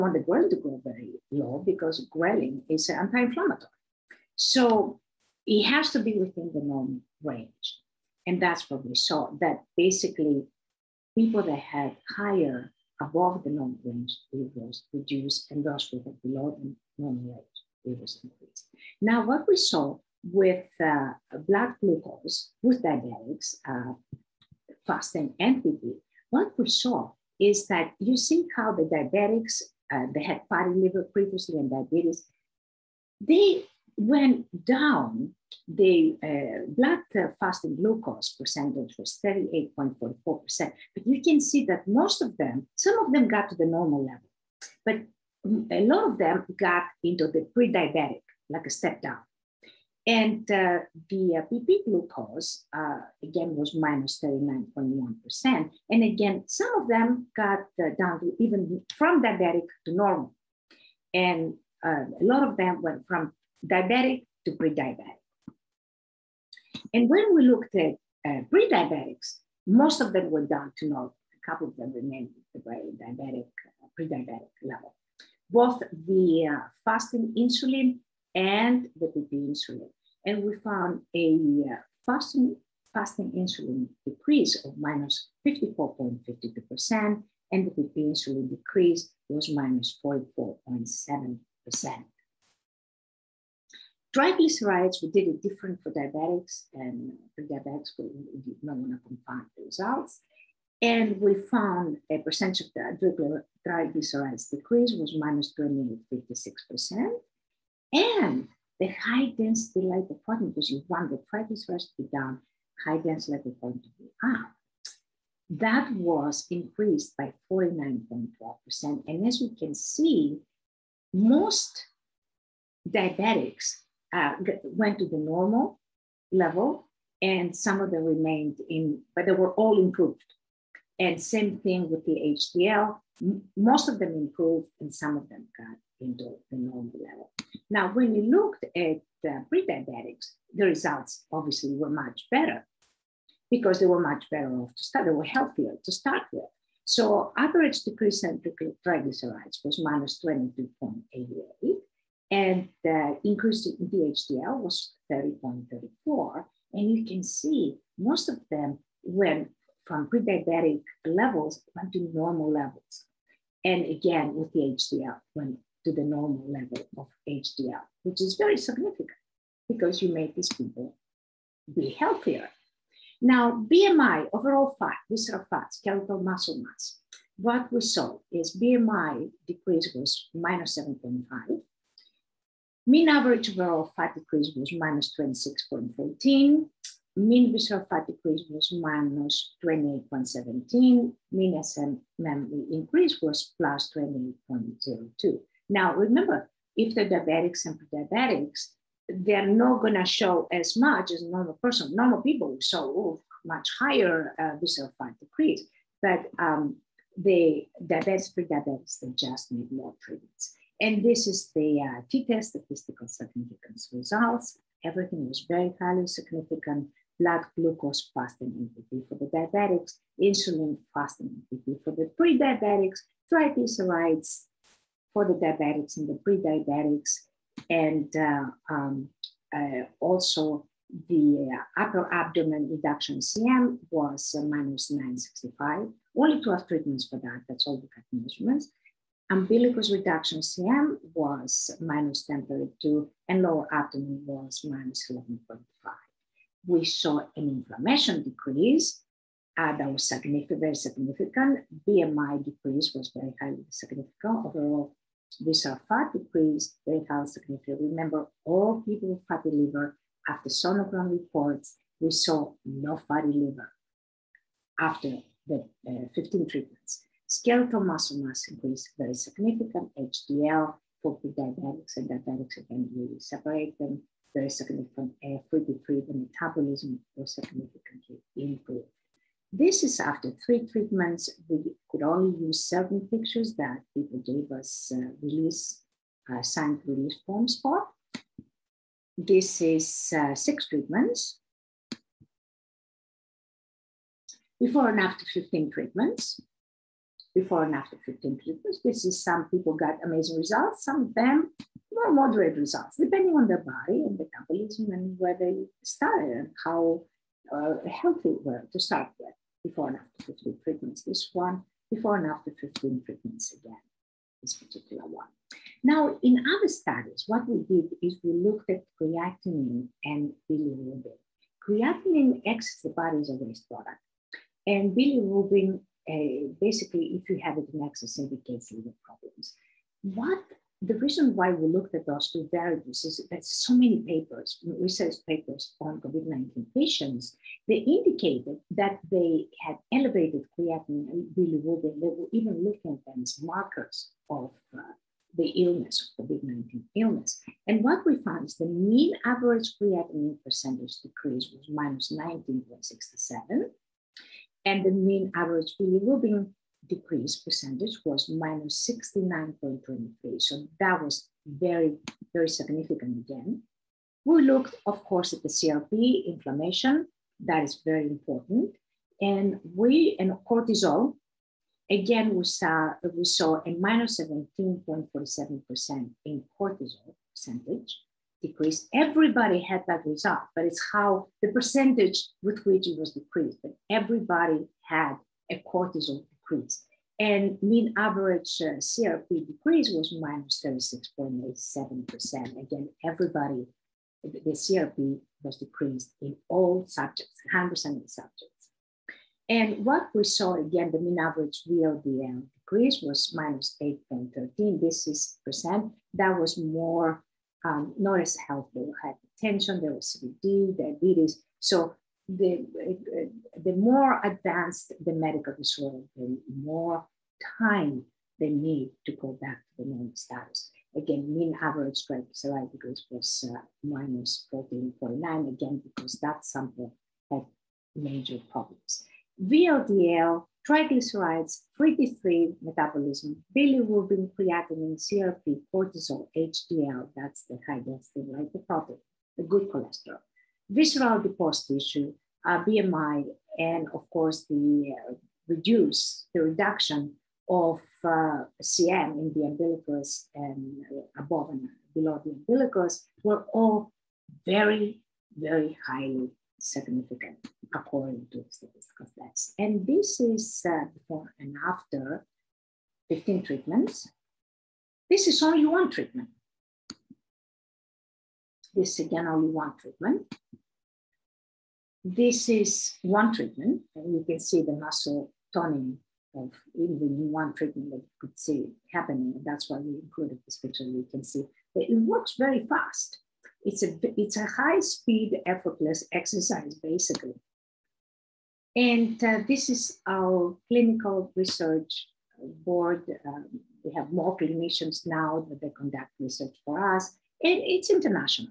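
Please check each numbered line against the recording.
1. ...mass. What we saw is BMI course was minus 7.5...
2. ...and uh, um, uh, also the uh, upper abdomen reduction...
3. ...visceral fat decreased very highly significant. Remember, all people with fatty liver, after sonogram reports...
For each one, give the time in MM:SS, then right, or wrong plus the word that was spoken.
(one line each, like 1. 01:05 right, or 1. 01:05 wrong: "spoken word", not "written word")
1. 02:56 wrong: "decrease", not "course"
2. 03:47 right
3. 04:15 right.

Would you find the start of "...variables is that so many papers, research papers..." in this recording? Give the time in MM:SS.
05:32.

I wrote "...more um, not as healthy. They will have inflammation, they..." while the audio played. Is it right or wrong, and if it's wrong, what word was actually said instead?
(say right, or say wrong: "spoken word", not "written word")
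wrong: "hypertension", not "inflammation".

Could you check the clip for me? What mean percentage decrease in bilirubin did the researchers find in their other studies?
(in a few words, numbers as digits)
69.23%.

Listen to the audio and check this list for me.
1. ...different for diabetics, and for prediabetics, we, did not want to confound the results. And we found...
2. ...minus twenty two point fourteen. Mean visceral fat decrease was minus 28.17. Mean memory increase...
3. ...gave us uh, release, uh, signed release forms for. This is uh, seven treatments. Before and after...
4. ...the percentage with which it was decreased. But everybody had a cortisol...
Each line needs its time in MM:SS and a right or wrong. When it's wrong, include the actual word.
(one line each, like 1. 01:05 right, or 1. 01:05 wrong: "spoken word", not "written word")
1. 01:35 wrong: "diabetics", not "prediabetics"
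2. 03:04 wrong: "six", not "two"
3. 04:44 wrong: "six", not "seven"
4. 06:21 right.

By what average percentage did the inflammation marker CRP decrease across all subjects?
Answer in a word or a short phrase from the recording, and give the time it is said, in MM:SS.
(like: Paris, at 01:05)
36.87%, at 06:30.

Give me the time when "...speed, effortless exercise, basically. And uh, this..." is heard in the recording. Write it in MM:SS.
08:04.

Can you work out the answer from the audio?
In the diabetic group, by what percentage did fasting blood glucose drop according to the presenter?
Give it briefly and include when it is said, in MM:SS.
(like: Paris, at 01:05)
38.44%, at 00:39.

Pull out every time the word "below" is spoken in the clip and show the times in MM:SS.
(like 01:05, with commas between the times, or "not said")
00:16, 07:31.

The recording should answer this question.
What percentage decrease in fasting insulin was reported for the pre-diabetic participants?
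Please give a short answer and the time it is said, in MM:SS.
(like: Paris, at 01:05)
54.52%, at 01:25.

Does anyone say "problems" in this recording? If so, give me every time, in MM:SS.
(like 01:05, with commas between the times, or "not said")
05:29, 07:08.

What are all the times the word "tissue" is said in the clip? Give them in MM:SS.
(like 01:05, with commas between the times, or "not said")
07:21.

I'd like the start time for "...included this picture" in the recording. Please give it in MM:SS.
07:59.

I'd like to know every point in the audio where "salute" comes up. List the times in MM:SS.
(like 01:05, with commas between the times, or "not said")
not said.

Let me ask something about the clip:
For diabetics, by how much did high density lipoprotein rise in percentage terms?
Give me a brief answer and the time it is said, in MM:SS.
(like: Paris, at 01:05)
49.12%, at 01:57.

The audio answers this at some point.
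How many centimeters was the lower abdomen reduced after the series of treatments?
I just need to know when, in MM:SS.
04:05.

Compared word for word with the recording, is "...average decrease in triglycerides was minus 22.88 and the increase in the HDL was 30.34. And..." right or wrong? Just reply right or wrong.
right.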